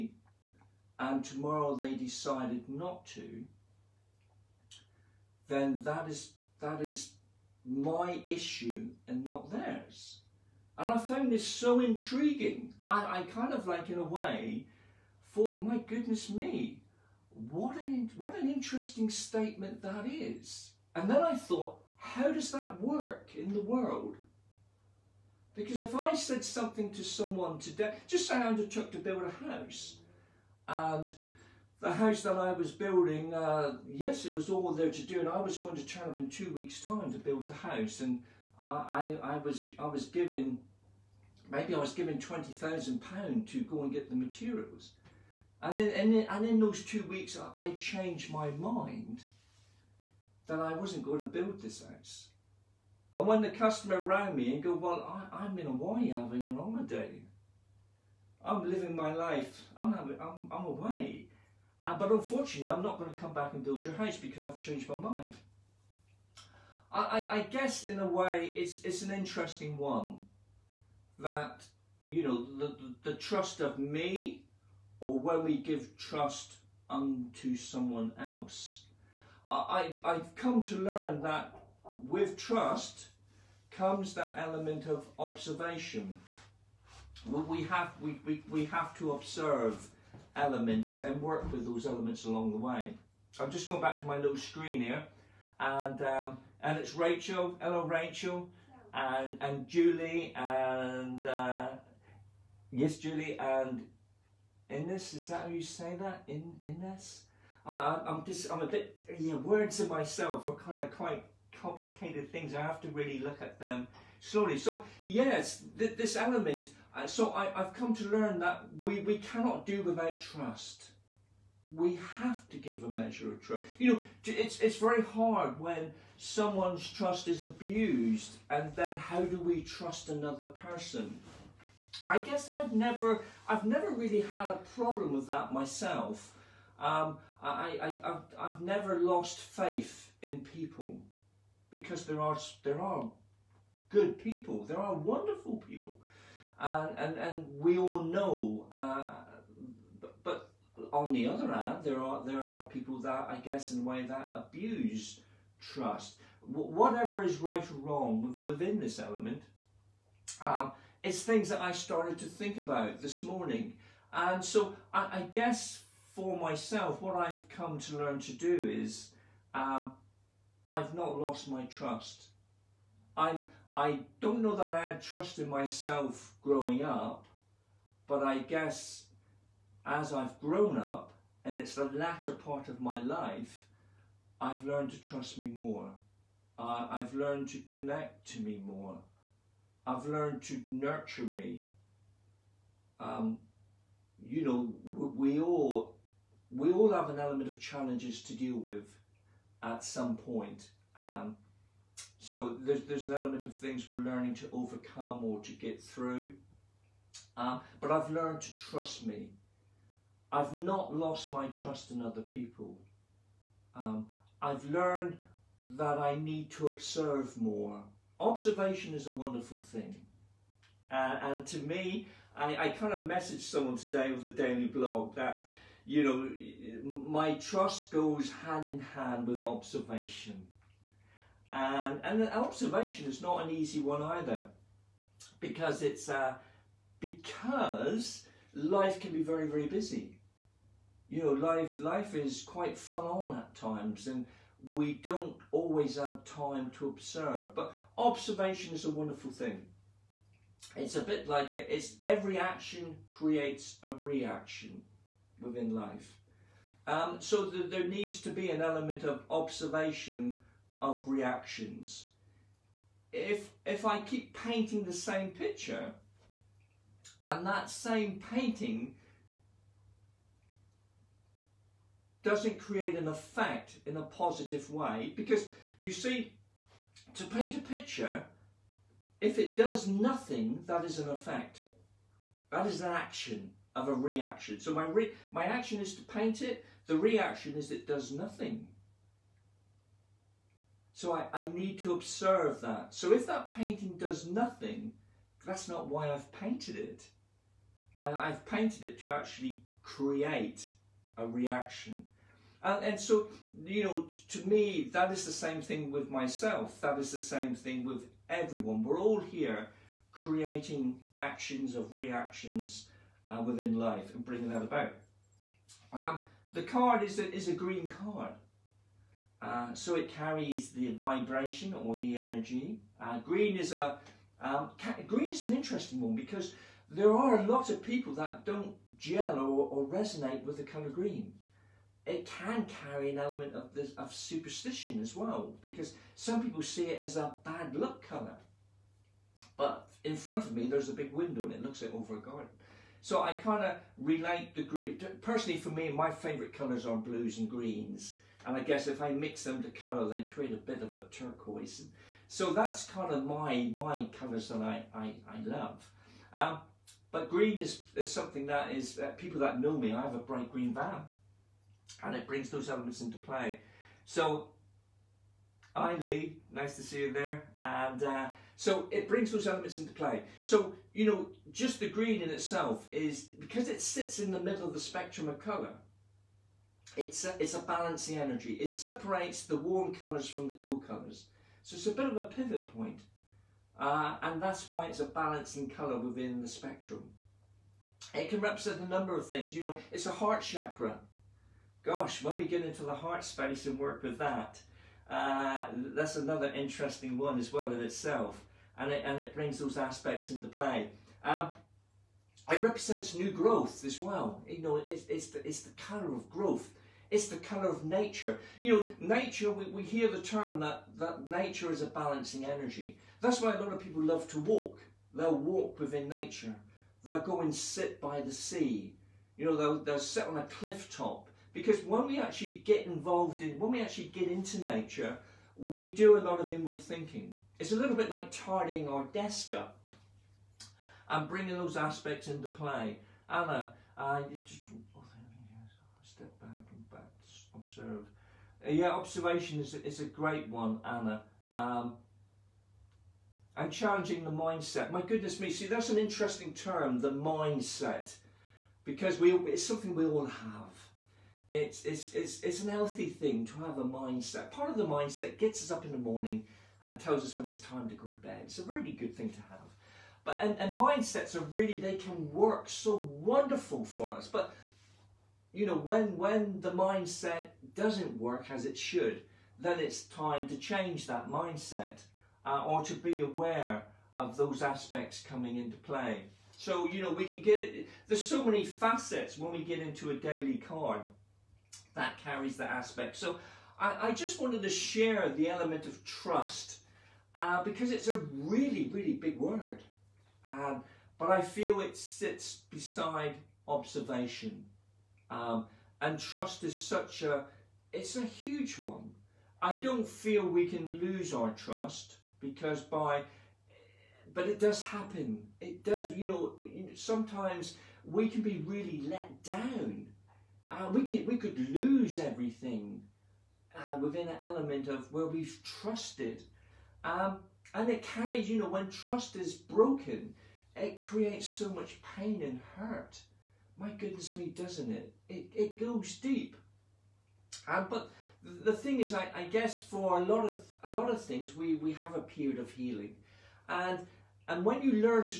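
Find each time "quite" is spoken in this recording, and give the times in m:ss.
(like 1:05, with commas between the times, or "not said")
1:50, 4:02.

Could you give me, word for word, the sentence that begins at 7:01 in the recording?
Because when we actually get involved in, when we actually get into nature, we do a lot of inward thinking.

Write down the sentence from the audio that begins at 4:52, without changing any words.
So if that painting does nothing, that's not why I've painted it.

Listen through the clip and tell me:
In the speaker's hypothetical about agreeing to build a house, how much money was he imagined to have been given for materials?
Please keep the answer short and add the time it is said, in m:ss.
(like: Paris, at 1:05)
£20,000, at 0:42.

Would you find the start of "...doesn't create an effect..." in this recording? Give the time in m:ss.
4:32.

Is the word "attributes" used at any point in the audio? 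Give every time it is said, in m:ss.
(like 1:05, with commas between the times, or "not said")
not said.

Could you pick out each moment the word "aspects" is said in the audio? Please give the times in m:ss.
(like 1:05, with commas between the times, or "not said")
6:39, 7:11, 7:54, 8:02.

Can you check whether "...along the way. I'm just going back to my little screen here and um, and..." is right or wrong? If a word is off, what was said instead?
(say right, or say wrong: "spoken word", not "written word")
right.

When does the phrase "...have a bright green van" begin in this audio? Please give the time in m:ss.
6:00.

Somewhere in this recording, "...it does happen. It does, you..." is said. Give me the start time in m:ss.
8:24.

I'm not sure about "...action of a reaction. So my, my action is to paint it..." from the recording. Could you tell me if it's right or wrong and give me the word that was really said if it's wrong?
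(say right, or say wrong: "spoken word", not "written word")
right.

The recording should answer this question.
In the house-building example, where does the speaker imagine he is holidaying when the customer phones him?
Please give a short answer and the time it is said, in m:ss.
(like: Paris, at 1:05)
Hawaii, at 0:55.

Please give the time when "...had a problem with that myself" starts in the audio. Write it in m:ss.
2:14.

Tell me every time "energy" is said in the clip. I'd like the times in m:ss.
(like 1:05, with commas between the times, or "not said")
5:22, 6:18, 6:52.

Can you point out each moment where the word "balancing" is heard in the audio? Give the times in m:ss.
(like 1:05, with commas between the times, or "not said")
6:17, 6:25, 6:51.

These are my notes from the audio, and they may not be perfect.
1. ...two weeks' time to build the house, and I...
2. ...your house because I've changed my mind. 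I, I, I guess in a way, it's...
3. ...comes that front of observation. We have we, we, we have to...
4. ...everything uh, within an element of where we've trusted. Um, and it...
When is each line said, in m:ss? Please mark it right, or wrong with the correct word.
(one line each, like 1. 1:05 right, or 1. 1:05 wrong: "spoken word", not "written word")
1. 0:36 right
2. 1:03 right
3. 1:23 wrong: "element", not "front"
4. 8:32 right.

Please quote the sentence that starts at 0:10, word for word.
And I found this so intriguing.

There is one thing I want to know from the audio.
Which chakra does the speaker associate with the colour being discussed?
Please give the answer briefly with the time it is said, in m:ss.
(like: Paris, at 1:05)
Heart chakra, at 6:30.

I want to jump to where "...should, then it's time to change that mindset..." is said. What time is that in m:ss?
7:48.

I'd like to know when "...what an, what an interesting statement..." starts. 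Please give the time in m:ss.
0:17.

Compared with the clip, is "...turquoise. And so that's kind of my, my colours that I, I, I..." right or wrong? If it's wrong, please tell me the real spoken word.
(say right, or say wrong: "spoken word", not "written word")
right.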